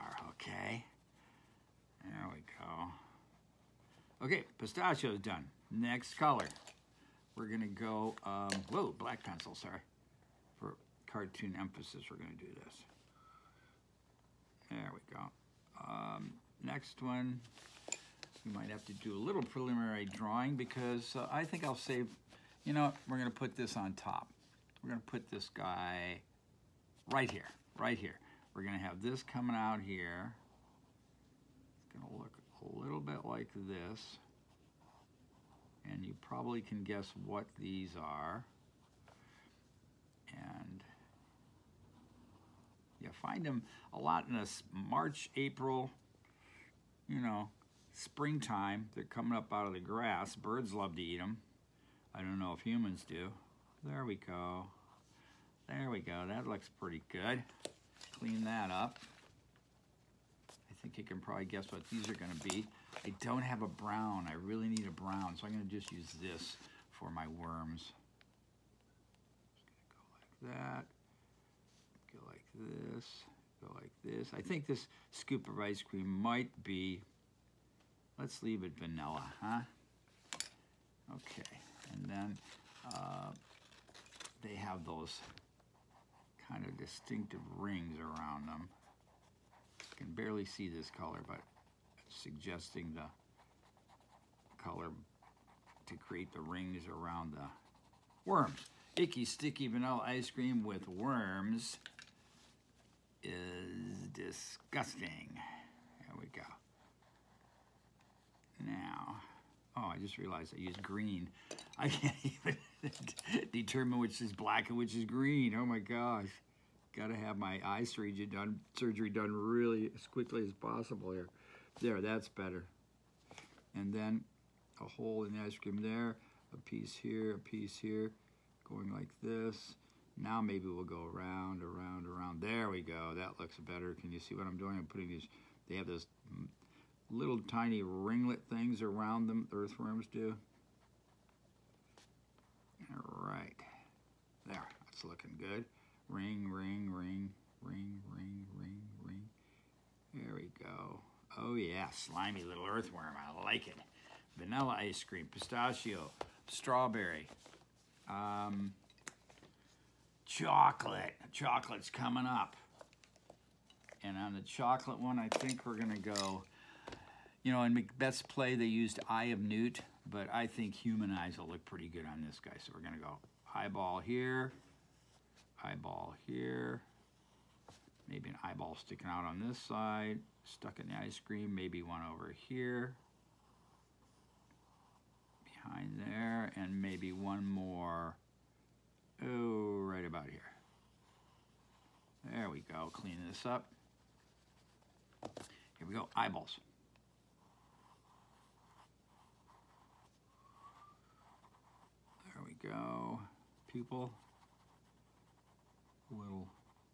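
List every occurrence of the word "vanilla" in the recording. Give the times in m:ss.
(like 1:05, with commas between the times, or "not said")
1:18, 1:39, 2:34.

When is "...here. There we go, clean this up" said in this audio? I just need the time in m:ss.
3:10.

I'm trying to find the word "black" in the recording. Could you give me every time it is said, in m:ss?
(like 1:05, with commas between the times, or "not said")
0:08, 1:54.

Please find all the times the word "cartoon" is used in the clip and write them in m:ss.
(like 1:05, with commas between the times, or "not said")
0:11.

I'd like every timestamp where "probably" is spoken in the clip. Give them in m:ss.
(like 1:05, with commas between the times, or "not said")
0:36, 1:01.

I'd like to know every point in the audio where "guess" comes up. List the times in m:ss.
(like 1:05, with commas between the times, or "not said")
0:36, 1:01.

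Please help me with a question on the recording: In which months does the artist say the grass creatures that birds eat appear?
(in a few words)
March, April.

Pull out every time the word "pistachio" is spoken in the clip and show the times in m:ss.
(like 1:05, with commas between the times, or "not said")
0:04, 2:35.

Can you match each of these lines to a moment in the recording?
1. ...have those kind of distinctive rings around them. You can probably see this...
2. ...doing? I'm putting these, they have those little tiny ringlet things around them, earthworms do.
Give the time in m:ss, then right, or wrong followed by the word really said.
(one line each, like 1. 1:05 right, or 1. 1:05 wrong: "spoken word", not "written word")
1. 1:24 wrong: "barely", not "probably"
2. 2:14 right.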